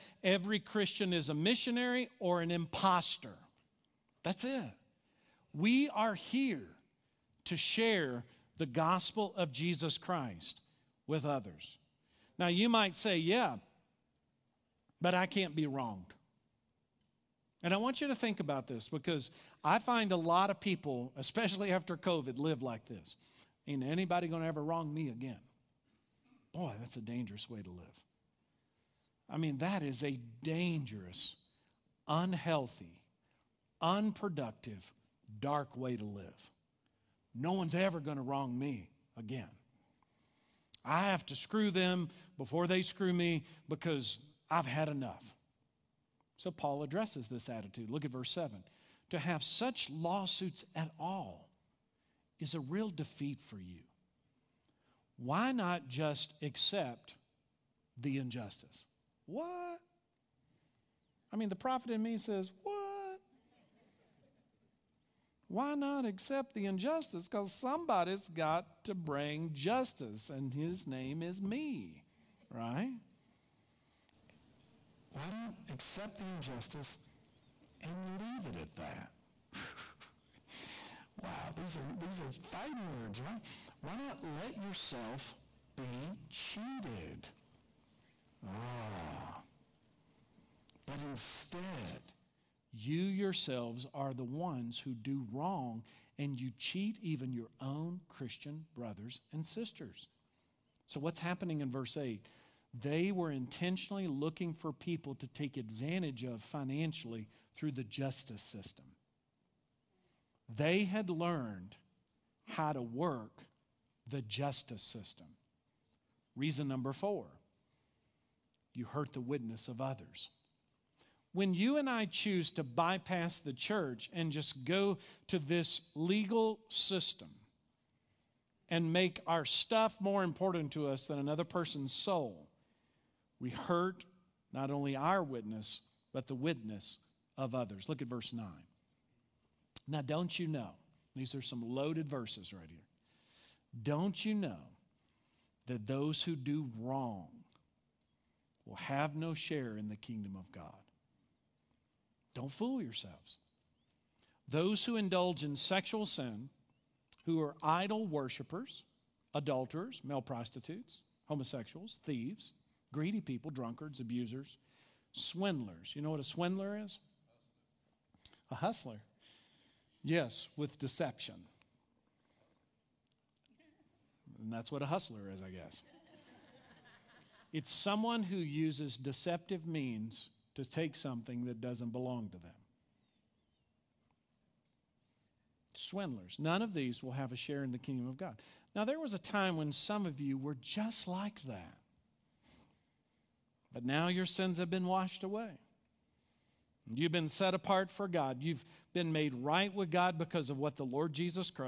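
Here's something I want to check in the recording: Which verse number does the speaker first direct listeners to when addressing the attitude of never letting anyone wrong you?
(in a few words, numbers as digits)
7.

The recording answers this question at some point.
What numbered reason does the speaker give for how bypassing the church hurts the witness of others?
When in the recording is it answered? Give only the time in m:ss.
1:56.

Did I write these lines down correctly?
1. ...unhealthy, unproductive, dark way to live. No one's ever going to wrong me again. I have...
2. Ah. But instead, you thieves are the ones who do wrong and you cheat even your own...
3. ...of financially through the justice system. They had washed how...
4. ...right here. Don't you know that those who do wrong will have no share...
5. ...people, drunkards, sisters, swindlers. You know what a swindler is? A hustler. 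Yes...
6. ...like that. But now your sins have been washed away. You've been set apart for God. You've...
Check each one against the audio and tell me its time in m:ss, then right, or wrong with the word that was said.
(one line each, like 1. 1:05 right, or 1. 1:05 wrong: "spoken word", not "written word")
1. 0:32 right
2. 1:28 wrong: "yourselves", not "thieves"
3. 1:46 wrong: "learned", not "washed"
4. 2:22 right
5. 2:43 wrong: "abusers", not "sisters"
6. 3:11 right.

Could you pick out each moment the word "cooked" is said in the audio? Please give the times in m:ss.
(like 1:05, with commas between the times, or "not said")
not said.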